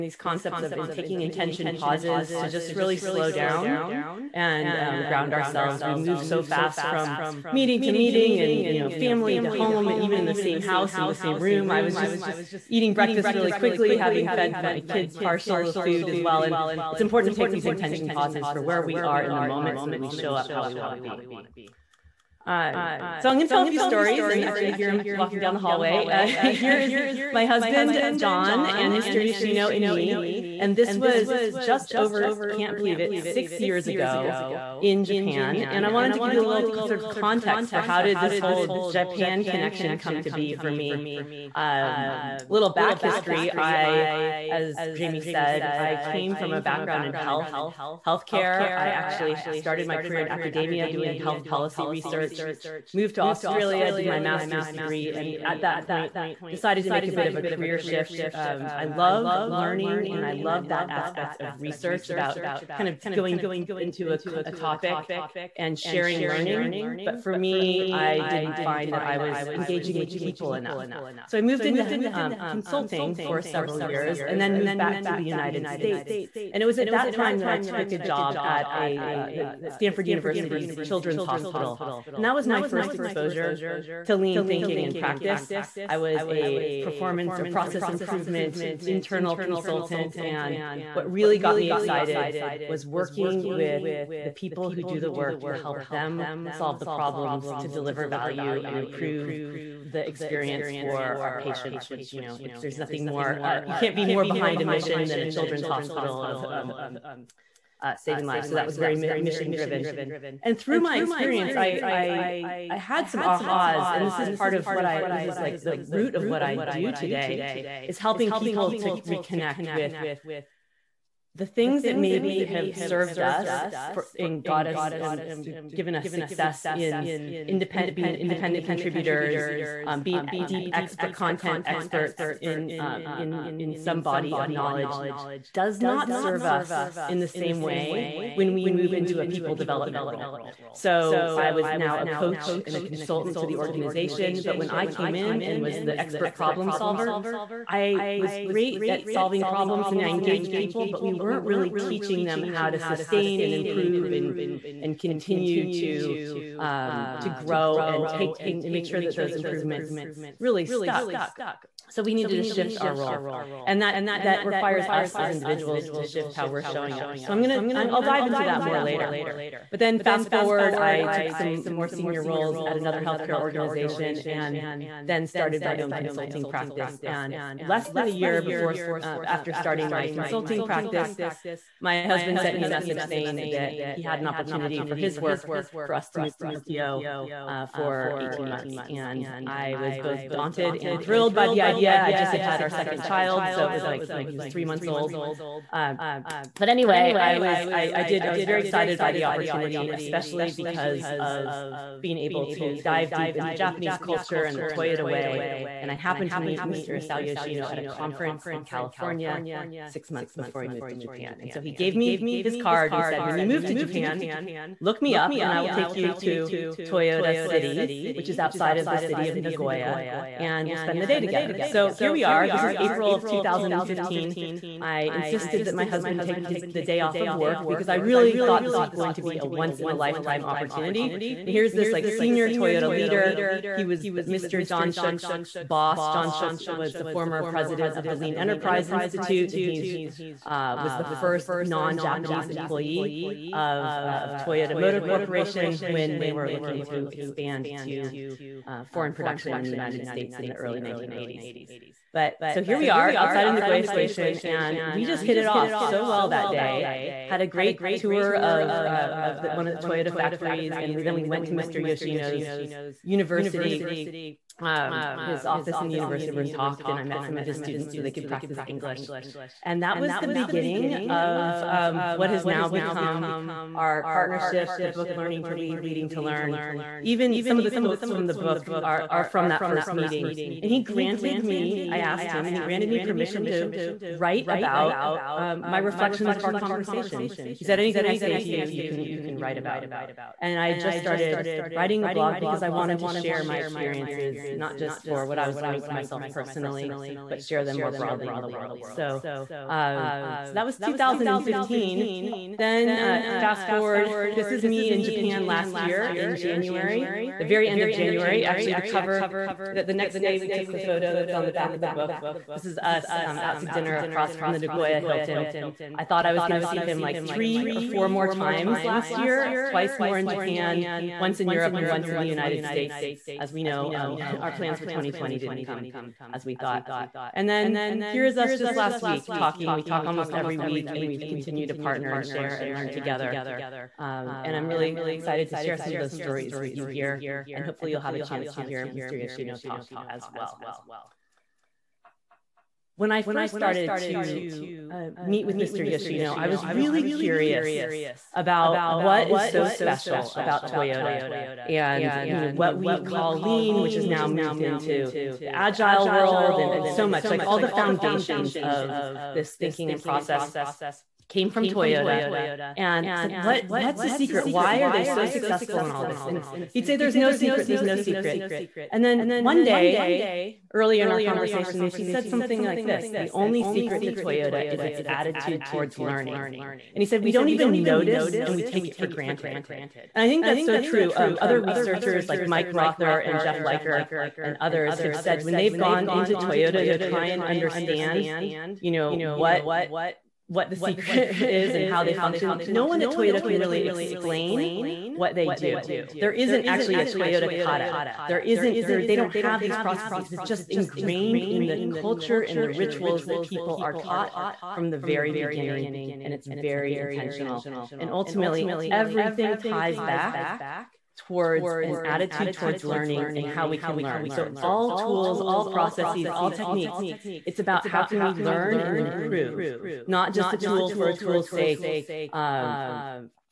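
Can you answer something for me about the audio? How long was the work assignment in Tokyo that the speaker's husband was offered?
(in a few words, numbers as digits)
18 months.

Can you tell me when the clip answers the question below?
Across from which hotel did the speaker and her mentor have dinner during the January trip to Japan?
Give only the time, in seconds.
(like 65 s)
314 s.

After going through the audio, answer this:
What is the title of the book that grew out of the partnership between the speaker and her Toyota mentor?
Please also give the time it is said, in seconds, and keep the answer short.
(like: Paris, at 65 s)
Learning to Lead, Leading to Learn, at 275 s.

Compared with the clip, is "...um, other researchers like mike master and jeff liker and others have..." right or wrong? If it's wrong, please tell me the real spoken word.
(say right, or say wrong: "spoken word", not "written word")
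wrong: "rother", not "master".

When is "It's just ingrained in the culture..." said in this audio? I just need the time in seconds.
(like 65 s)
400 s.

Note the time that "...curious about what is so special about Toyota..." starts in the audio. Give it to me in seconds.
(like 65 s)
347 s.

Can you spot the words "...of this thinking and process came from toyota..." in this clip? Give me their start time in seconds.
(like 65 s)
358 s.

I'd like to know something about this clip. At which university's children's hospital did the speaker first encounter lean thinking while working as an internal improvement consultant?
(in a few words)
Stanford University.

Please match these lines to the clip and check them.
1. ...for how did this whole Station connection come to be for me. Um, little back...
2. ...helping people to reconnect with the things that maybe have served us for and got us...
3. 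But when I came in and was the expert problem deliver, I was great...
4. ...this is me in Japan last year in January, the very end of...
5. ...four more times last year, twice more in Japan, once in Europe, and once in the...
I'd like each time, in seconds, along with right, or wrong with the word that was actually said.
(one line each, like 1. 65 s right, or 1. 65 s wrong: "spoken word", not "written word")
1. 37 s wrong: "Japan", not "Station"
2. 117 s right
3. 144 s wrong: "solver", not "deliver"
4. 304 s right
5. 317 s right.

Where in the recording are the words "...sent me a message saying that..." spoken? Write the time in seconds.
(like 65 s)
182 s.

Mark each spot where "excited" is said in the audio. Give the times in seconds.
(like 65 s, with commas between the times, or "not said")
91 s, 198 s, 335 s.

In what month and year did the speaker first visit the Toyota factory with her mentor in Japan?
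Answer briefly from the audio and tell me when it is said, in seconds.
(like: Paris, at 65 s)
April 2015, at 222 s.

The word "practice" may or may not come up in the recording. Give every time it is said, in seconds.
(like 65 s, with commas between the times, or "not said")
84 s, 176 s, 180 s, 268 s.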